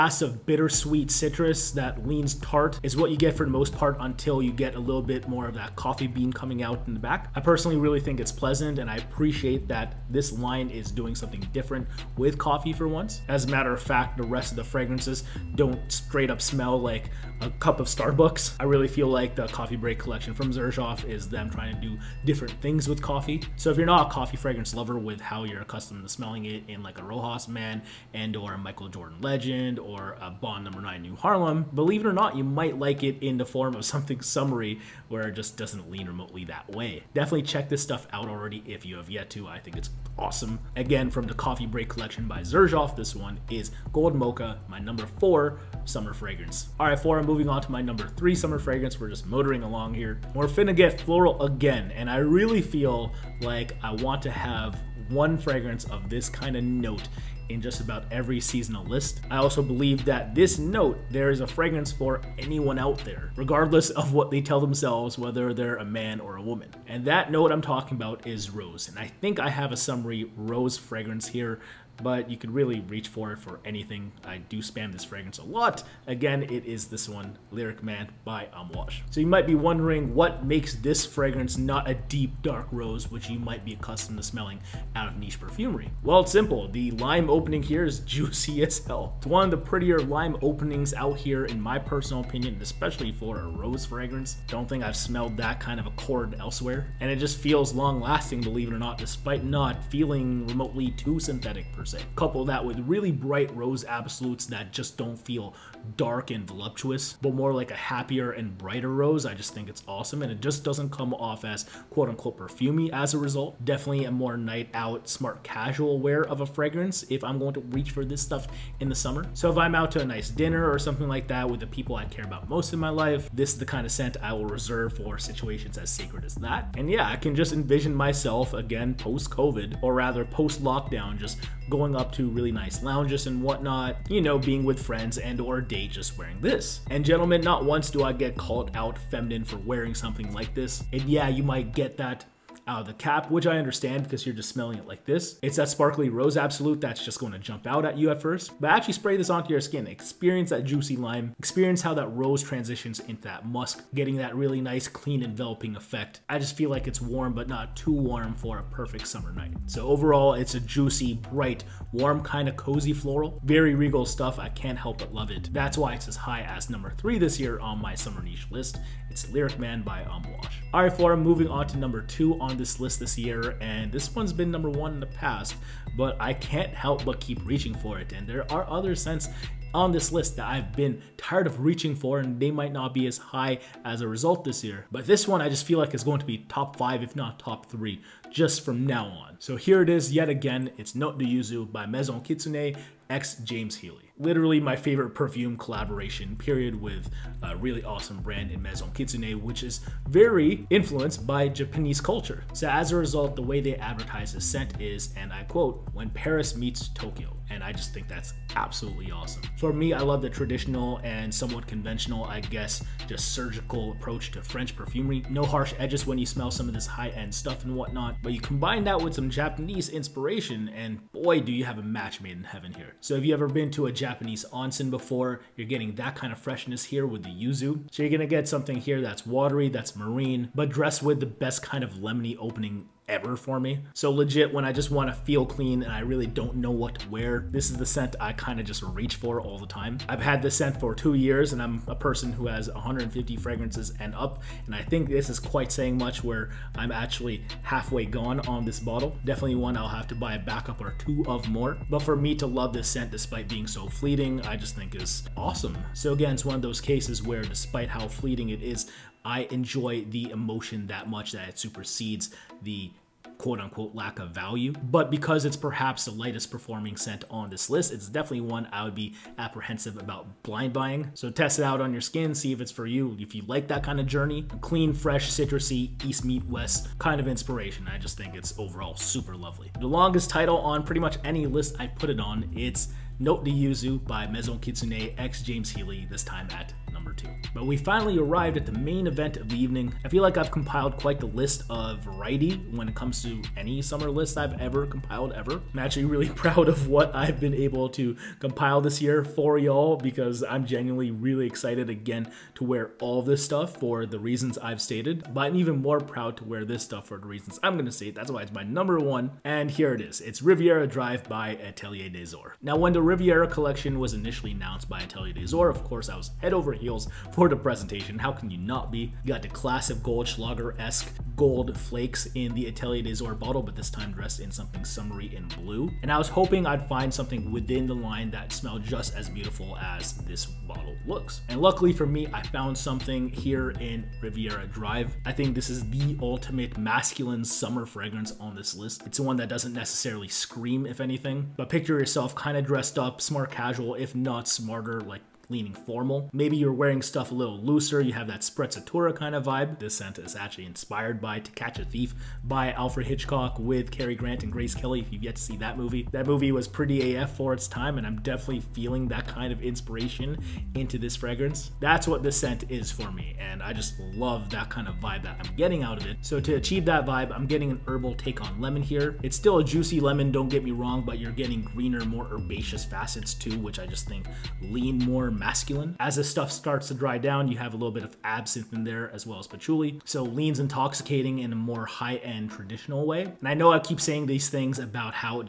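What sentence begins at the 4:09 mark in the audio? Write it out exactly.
Definitely one I'll have to buy a backup or two of more.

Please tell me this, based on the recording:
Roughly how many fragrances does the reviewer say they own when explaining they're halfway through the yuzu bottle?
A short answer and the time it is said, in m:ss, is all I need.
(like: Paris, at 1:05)
150, at 4:02.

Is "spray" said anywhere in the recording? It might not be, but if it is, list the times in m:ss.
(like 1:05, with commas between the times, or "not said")
2:28.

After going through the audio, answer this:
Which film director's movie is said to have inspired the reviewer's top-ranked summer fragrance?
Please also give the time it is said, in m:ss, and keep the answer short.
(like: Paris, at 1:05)
Alfred Hitchcock, at 5:52.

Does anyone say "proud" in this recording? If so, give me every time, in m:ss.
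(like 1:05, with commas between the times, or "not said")
4:56, 5:06.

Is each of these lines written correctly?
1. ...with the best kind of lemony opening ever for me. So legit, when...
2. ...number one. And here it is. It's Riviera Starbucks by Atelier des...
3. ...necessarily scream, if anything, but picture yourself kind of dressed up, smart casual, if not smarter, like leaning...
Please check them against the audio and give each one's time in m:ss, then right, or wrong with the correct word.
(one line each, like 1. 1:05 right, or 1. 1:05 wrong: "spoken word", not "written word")
1. 3:51 right
2. 5:08 wrong: "Drive", not "Starbucks"
3. 5:39 right.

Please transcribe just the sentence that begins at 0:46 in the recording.
All right, four, I'm moving on to my number three summer fragrance.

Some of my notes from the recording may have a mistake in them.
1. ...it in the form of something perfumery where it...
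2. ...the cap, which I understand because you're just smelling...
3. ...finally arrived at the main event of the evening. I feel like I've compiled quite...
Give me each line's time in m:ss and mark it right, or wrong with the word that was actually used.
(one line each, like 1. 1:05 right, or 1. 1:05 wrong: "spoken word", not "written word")
1. 0:33 wrong: "summery", not "perfumery"
2. 2:22 right
3. 4:47 right.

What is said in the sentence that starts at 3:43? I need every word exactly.
So if you ever been to a Japanese onsen before, you're getting that kind of freshness here with the yuzu.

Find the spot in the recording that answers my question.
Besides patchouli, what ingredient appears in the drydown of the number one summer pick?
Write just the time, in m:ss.
6:18.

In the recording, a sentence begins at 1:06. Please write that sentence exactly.
And that note I'm talking about is rose.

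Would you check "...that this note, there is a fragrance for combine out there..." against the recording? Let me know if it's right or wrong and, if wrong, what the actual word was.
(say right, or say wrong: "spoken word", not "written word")
wrong: "anyone", not "combine".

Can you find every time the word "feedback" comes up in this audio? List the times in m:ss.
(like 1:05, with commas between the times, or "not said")
not said.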